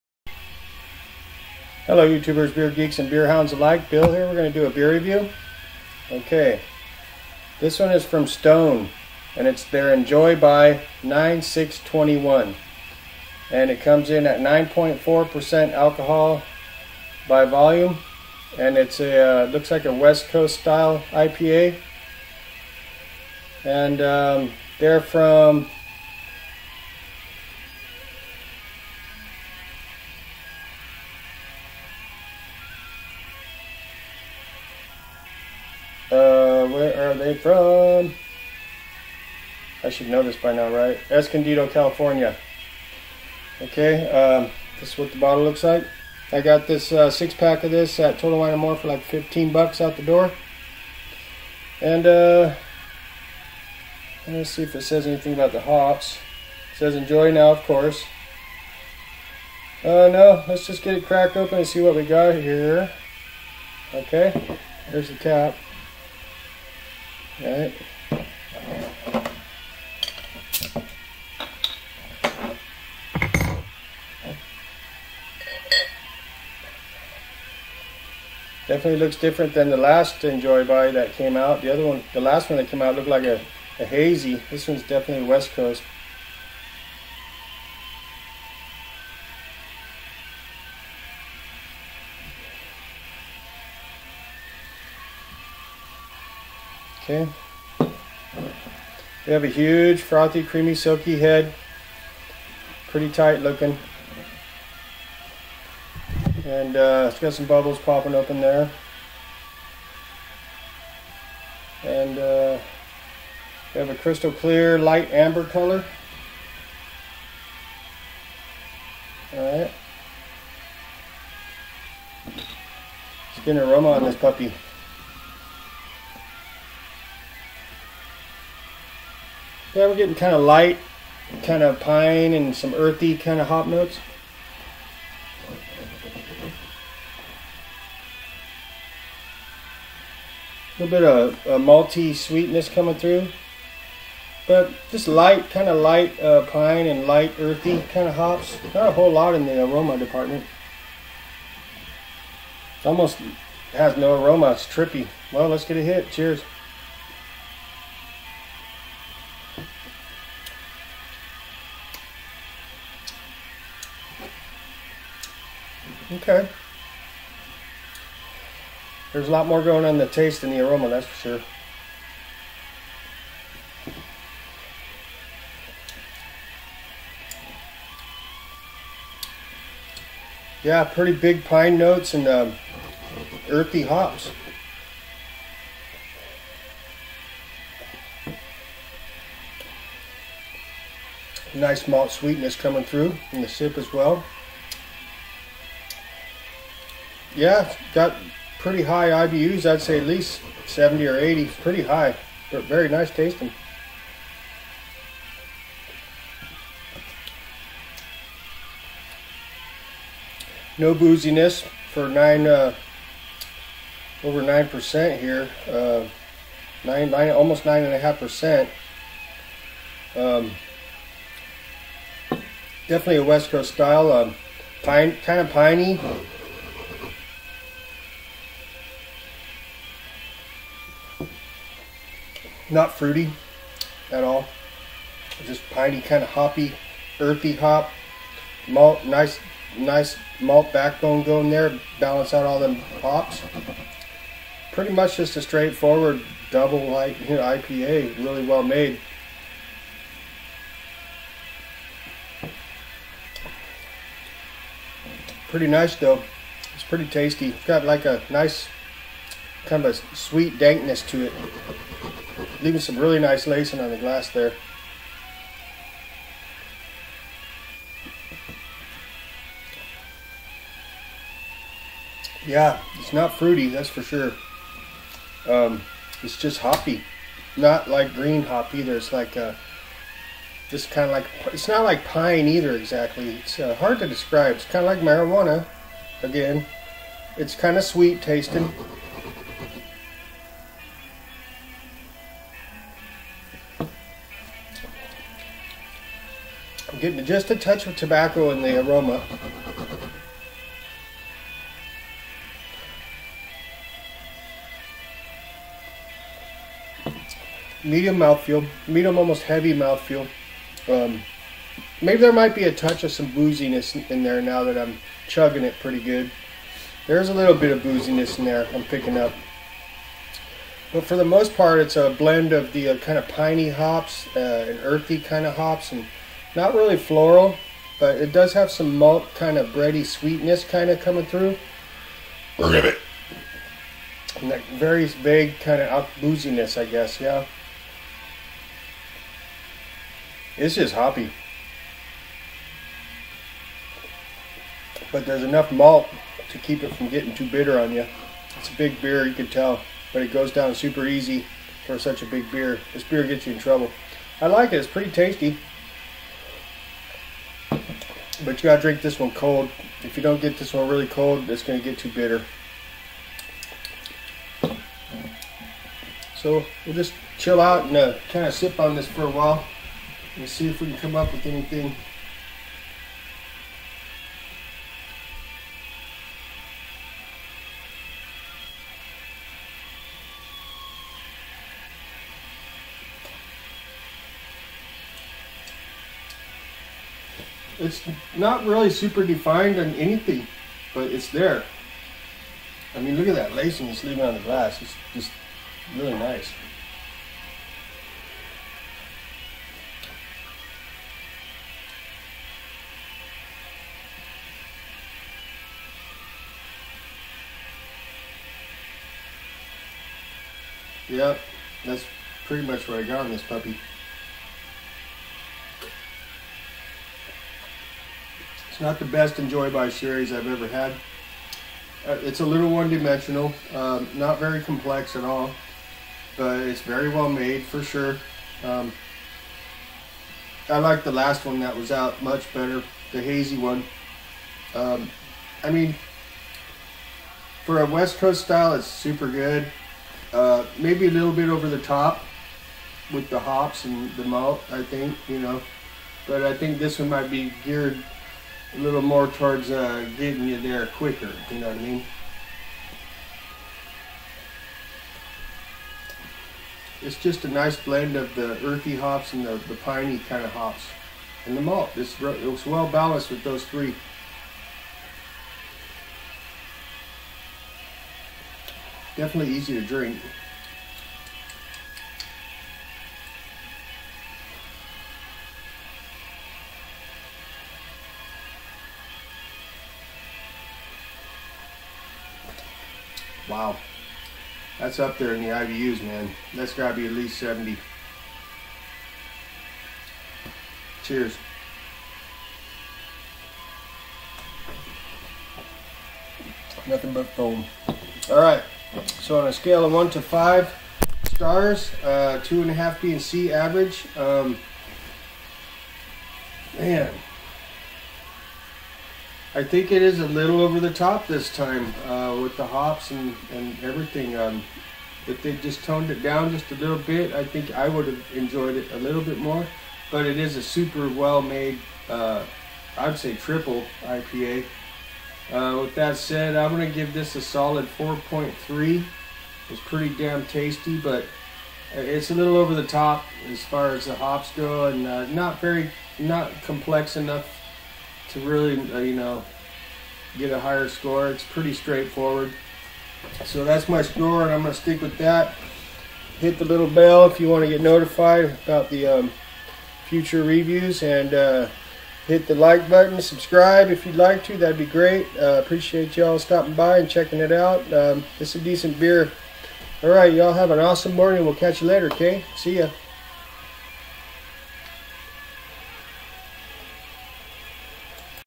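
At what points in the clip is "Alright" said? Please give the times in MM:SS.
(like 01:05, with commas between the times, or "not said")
01:07, 01:59.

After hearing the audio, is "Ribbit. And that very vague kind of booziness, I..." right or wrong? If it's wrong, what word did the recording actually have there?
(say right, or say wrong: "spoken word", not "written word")
right.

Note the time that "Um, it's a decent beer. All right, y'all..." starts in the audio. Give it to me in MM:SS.
09:17.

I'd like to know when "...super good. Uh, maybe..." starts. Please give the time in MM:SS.
07:18.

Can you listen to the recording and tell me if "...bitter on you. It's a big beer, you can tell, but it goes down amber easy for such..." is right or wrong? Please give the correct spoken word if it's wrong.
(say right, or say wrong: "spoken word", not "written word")
wrong: "super", not "amber".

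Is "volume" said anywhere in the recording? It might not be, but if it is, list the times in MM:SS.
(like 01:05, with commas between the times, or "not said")
00:17.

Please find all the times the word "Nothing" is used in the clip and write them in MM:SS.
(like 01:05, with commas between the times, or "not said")
08:16.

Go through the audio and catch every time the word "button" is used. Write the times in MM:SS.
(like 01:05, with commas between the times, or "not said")
09:12.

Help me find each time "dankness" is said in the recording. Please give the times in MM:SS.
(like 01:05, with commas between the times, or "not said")
04:20.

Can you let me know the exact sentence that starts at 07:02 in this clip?
Uh, it's a little one-dimensional, um, not very complex at all, but it's very well made for sure.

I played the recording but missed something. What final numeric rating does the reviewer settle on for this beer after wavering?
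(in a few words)
4.3.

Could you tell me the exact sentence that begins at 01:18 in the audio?
Definitely looks different than the last Enjoy By that came out.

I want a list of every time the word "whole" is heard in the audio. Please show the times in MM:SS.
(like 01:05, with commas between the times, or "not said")
02:28.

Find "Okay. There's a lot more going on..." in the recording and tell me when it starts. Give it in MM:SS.
02:46.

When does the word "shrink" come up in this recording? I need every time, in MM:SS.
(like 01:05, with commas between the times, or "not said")
not said.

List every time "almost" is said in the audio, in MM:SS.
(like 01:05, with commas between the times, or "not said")
02:32, 03:37, 05:09.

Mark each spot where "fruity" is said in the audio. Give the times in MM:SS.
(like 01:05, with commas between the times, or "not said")
03:52, 04:33.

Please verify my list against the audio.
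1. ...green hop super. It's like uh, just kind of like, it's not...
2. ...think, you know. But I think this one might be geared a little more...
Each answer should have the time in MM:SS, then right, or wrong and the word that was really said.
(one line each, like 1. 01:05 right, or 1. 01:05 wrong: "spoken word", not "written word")
1. 04:38 wrong: "either", not "super"
2. 07:24 right.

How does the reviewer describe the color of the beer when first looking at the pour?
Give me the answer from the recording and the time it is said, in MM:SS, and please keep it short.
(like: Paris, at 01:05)
light amber, at 01:54.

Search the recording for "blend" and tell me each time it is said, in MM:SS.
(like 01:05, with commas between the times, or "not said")
05:22, 07:37.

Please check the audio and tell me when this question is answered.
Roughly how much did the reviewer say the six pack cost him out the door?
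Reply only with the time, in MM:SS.
00:49.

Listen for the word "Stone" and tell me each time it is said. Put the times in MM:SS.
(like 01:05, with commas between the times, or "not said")
00:08.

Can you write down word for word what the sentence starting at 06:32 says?
I mean, look at that lacing it's leaving on the glass.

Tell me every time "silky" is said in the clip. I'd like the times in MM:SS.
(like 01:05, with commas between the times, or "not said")
01:40.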